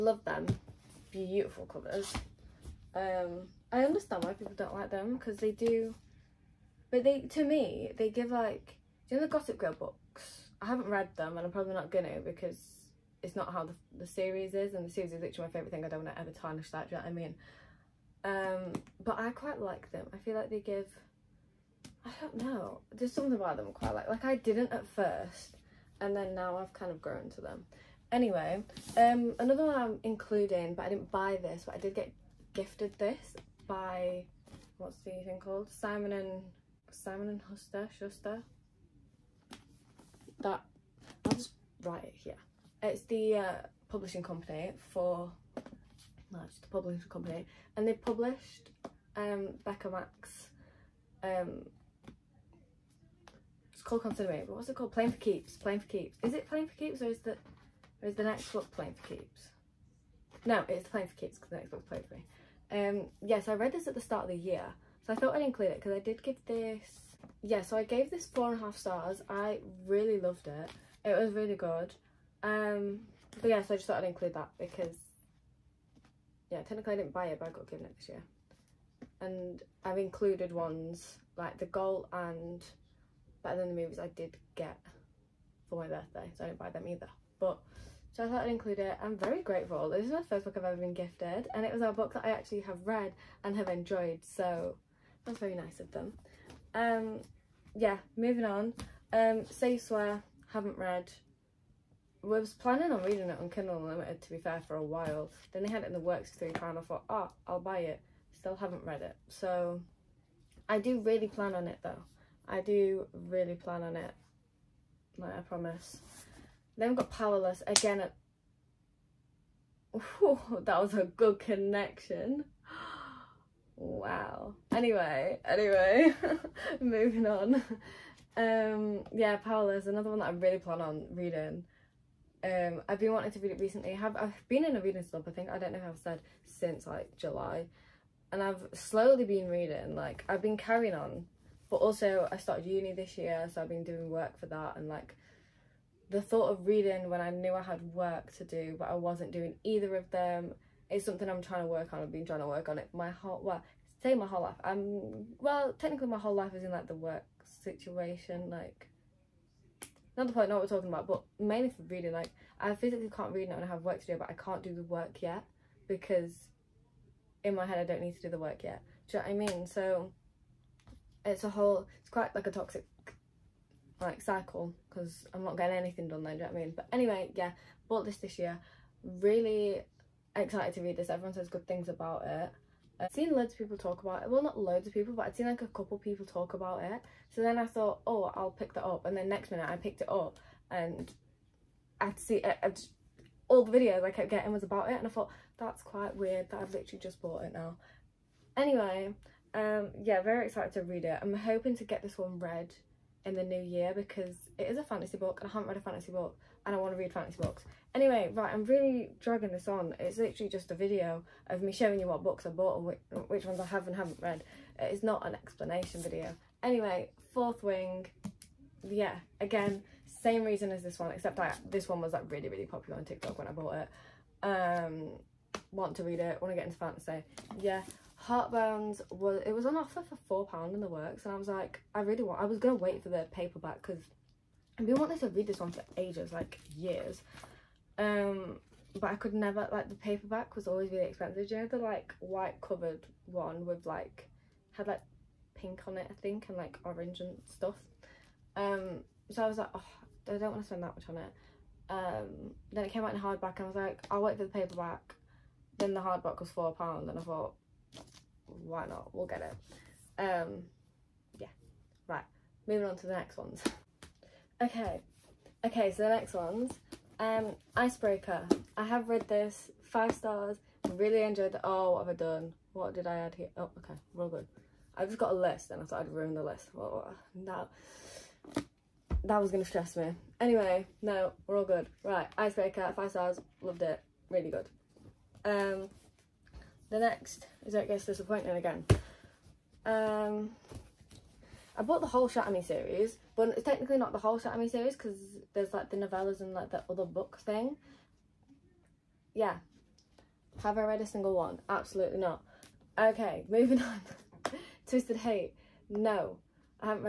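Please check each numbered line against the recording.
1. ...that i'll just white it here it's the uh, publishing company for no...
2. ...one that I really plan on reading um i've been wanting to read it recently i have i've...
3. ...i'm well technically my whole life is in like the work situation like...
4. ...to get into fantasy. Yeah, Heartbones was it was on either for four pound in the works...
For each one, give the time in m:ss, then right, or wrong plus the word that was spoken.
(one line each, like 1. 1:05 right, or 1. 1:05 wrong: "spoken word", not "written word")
1. 0:40 wrong: "write", not "white"
2. 2:10 right
3. 2:34 right
4. 3:46 wrong: "offer", not "either".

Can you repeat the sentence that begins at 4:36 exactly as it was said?
Well, that, that was going to stress me.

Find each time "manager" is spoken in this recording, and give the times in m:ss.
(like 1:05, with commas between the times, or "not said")
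not said.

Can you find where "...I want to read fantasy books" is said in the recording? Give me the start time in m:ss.
3:26.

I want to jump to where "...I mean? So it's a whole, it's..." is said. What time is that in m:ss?
2:49.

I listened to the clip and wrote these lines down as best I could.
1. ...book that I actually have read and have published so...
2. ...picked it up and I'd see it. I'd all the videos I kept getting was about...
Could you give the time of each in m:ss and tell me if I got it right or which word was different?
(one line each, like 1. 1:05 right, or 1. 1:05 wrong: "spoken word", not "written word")
1. 1:31 wrong: "enjoyed", not "published"
2. 3:09 right.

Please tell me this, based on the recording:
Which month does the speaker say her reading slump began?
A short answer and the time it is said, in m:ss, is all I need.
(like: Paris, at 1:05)
July, at 2:17.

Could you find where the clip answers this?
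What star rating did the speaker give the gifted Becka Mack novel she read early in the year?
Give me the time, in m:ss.
1:08.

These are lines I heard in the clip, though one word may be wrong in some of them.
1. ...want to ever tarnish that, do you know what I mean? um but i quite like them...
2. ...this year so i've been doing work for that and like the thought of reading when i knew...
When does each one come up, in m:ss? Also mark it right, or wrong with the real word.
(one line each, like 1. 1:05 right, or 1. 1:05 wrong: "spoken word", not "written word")
1. 0:16 right
2. 2:22 right.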